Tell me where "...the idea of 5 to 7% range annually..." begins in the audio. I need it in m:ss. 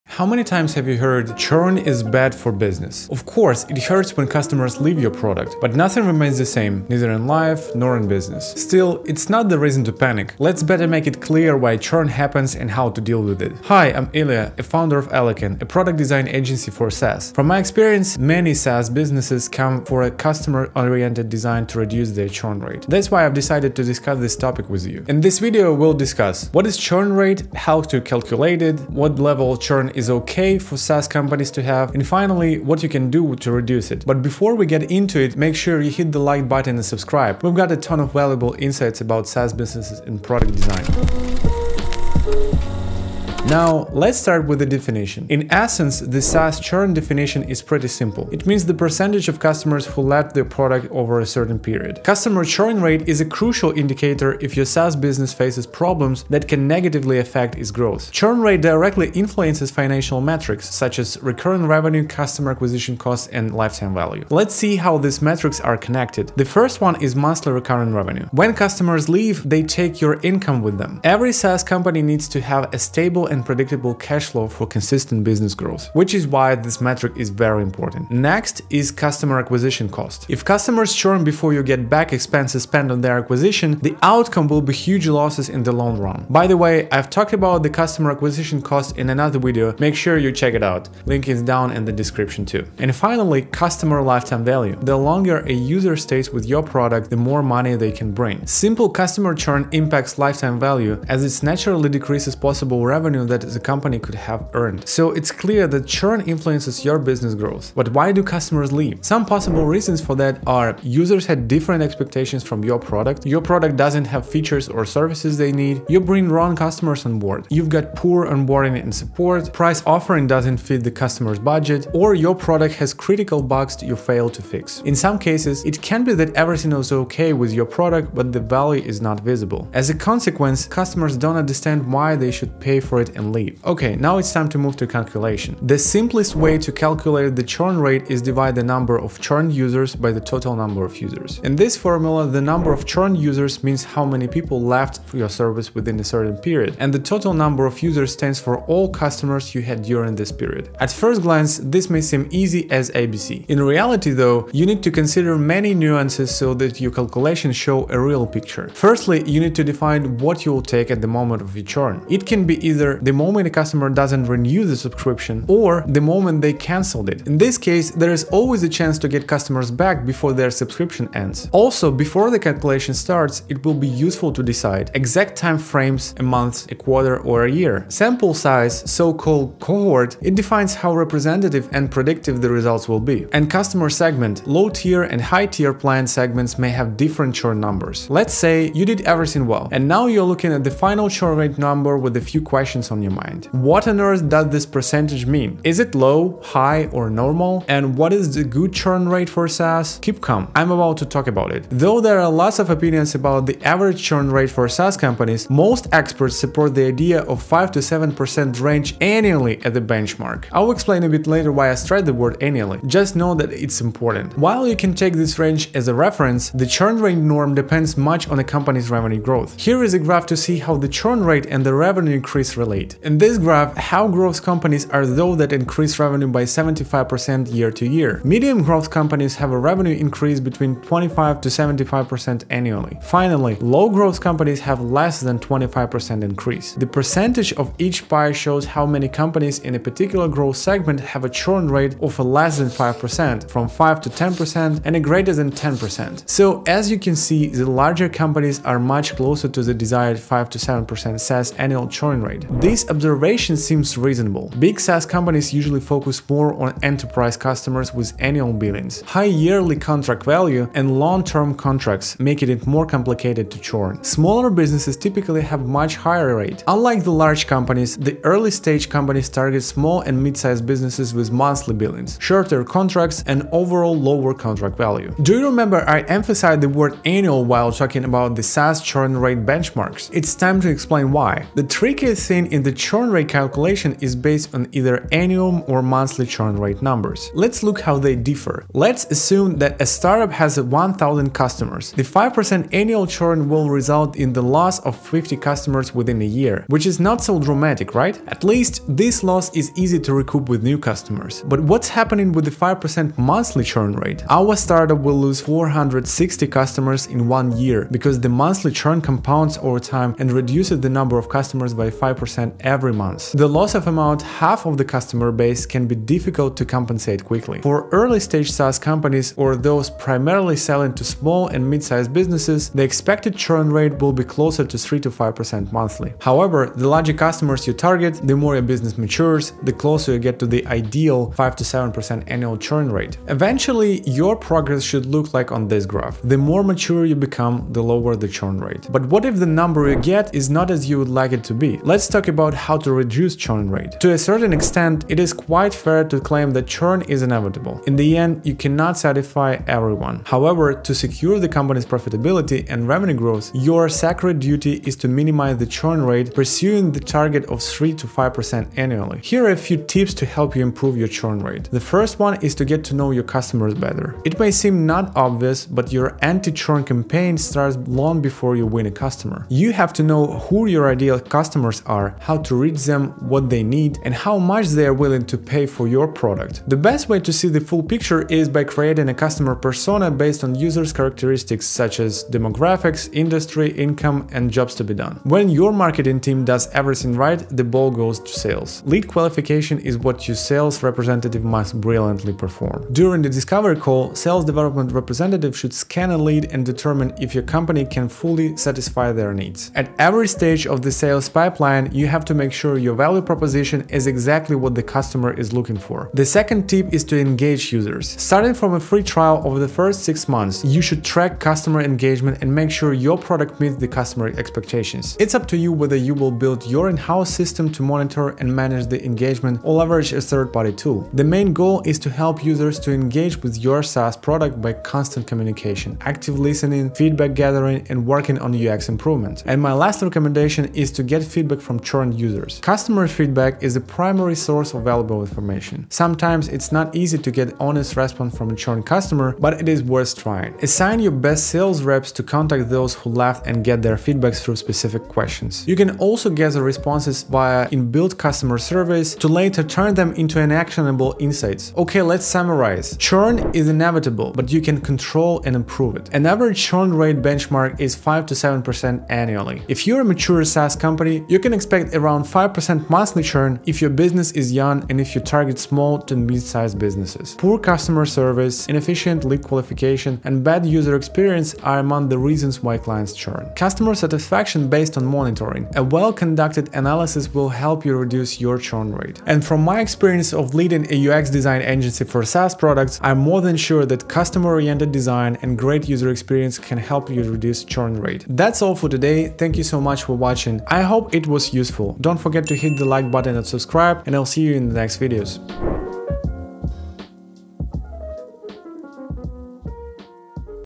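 3:26.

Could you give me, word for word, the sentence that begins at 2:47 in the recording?
In this case, there is always a chance to get customers back before their subscription ends.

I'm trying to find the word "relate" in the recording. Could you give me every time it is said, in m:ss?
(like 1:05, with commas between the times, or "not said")
3:42.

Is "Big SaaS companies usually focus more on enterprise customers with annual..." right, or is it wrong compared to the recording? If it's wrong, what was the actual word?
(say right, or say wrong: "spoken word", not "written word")
right.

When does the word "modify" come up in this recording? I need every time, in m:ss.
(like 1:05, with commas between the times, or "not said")
not said.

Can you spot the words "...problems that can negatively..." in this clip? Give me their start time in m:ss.
0:55.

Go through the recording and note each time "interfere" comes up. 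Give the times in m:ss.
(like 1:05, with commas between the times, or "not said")
not said.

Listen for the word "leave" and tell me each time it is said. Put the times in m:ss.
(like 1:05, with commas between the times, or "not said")
0:04, 1:09, 1:48, 2:13.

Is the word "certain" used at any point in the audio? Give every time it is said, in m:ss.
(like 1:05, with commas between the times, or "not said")
0:51, 2:26, 5:44.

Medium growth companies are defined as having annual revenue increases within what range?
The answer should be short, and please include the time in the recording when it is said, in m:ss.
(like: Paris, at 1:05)
25 to 75%, at 3:50.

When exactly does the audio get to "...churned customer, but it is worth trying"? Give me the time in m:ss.
7:18.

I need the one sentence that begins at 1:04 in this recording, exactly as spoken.
Let's see how these metrics are connected.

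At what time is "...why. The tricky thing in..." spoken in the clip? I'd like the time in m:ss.
4:41.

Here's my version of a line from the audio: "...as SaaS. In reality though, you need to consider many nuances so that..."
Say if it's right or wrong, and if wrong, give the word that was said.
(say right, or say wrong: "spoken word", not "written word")
wrong: "ABC", not "SaaS".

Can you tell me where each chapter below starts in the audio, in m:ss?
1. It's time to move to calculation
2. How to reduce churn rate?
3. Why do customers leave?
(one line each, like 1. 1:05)
1. 2:15
2. 5:43
3. 1:48.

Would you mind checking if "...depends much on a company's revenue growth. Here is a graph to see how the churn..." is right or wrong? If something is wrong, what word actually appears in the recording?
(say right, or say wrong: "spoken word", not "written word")
right.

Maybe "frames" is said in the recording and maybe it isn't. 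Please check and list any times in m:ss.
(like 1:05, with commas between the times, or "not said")
2:55.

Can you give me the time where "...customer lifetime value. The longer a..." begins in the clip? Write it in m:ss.
1:33.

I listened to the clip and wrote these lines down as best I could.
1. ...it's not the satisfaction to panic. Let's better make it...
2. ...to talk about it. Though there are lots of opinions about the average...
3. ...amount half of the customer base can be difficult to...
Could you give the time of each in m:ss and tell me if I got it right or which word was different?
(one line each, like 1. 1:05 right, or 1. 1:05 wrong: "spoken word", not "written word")
1. 0:09 wrong: "reason", not "satisfaction"
2. 3:20 right
3. 5:13 right.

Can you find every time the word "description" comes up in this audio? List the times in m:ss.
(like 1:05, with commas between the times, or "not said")
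1:32.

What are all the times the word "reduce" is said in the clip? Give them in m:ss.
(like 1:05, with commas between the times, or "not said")
0:21, 0:33, 5:10, 5:42, 7:57, 8:07.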